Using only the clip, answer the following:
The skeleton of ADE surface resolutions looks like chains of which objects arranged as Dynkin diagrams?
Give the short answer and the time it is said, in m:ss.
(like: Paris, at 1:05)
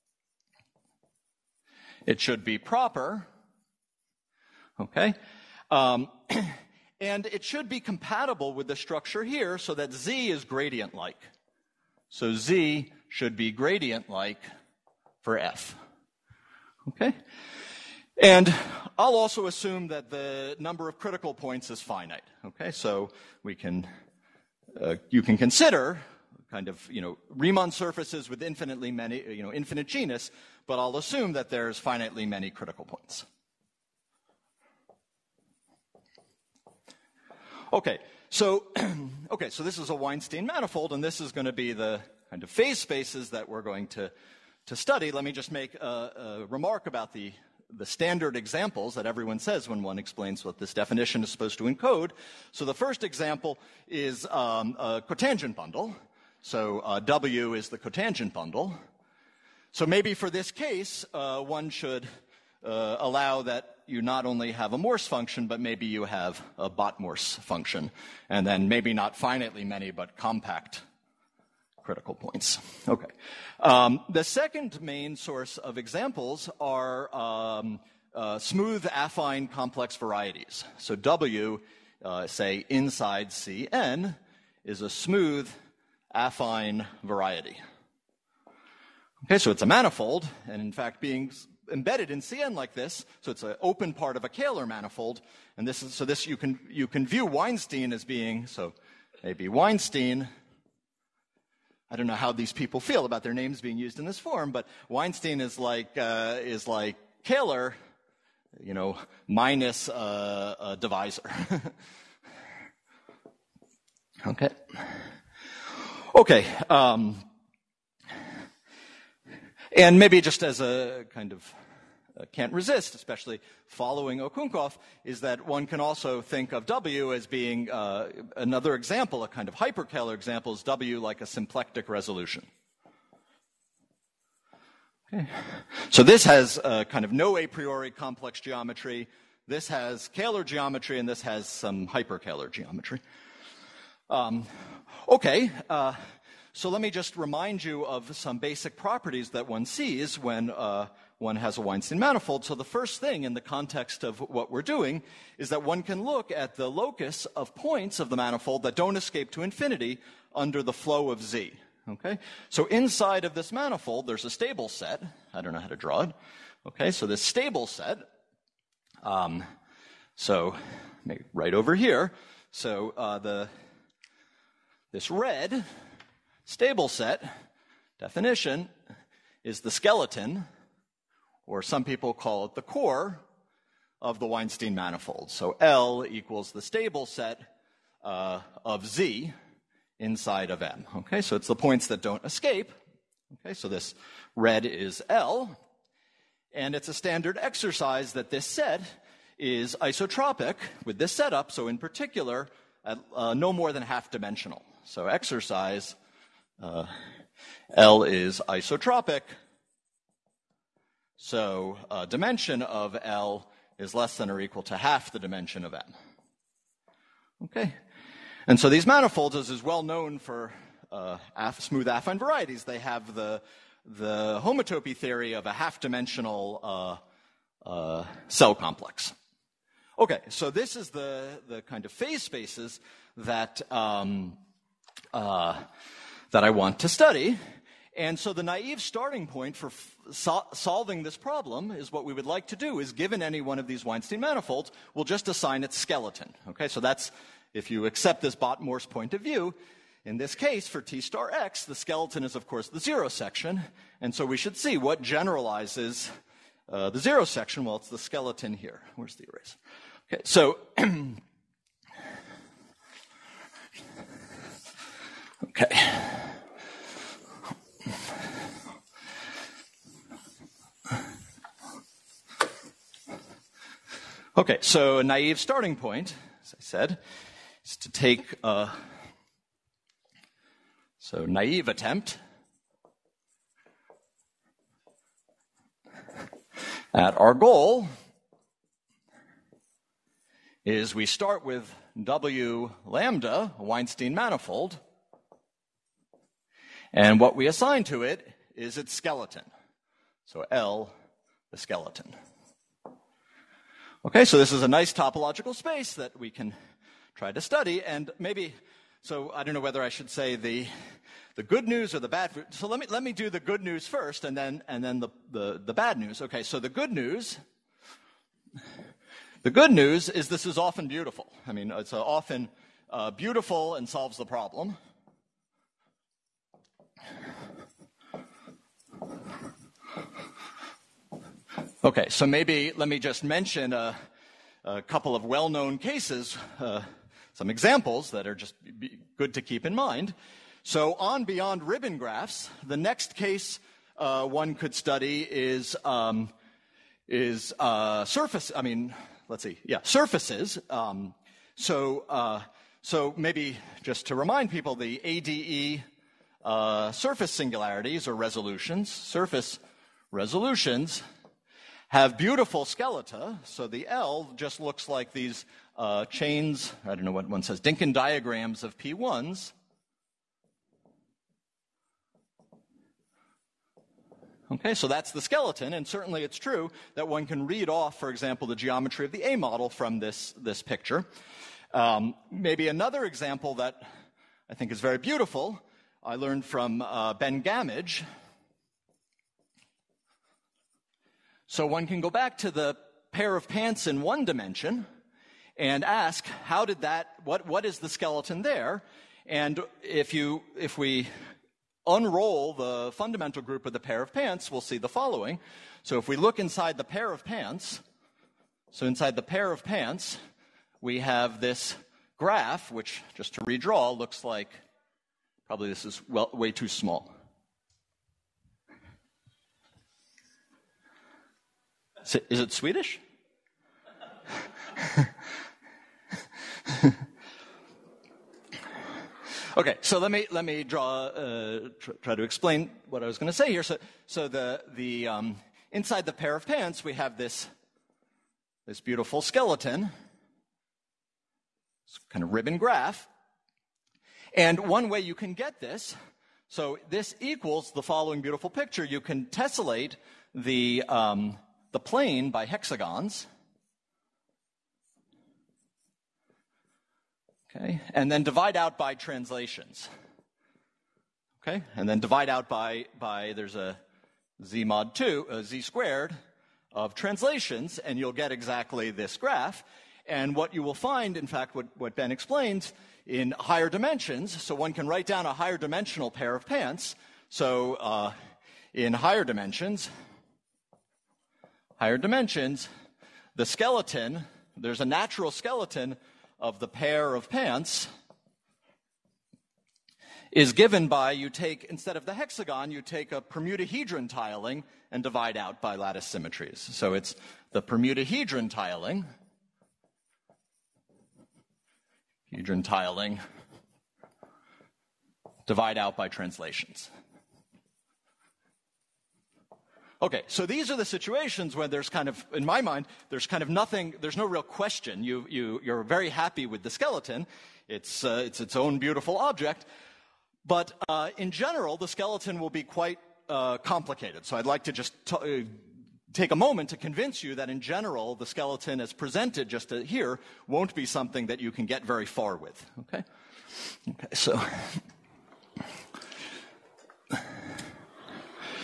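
P1s, at 6:08.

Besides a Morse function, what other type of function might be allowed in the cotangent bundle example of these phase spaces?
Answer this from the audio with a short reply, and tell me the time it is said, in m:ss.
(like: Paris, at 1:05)
Bott-Morse function, at 1:06.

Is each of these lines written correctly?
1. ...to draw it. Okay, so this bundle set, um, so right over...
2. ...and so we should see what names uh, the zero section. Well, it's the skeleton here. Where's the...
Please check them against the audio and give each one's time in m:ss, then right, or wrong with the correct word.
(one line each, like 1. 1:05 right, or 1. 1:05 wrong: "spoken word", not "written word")
1. 2:45 wrong: "stable", not "bundle"
2. 4:14 wrong: "generalizes", not "names".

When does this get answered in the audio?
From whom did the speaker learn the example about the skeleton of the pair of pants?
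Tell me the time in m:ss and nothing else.
6:27.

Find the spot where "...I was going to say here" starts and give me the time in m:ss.
7:13.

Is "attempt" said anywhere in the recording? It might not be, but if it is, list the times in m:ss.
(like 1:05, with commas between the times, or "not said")
4:41.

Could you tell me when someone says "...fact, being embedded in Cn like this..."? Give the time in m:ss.
1:30.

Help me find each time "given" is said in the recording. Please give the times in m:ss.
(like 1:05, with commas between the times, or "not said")
4:02, 8:10.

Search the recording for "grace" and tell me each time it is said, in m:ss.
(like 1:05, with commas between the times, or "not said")
not said.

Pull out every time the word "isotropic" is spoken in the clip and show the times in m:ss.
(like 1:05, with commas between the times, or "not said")
3:19, 3:28.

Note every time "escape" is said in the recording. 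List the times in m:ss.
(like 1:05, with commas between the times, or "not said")
2:38, 3:12.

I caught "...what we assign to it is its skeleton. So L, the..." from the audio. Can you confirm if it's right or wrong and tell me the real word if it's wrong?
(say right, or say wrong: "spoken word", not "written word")
right.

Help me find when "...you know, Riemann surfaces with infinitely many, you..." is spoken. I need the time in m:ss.
0:26.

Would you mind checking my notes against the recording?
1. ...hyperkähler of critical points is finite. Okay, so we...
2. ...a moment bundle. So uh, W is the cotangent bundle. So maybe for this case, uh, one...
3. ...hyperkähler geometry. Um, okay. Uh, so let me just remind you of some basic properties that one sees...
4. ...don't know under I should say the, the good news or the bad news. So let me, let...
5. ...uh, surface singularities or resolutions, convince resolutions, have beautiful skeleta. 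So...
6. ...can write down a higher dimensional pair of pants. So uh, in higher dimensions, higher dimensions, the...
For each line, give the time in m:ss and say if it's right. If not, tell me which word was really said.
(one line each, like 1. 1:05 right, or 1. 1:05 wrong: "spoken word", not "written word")
1. 0:20 wrong: "number", not "hyperkähler"
2. 0:54 wrong: "cotangent", not "moment"
3. 2:21 right
4. 5:09 wrong: "whether", not "under"
5. 5:56 wrong: "surface", not "convince"
6. 7:54 right.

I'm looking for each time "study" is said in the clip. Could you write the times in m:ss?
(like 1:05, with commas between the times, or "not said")
0:44, 3:56, 5:07, 5:44.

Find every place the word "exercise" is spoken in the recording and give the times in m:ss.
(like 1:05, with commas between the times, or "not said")
3:17, 3:25.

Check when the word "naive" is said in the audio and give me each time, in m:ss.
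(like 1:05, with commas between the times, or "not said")
3:58, 4:35, 4:41.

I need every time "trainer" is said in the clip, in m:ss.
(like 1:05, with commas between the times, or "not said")
not said.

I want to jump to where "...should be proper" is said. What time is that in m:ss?
0:02.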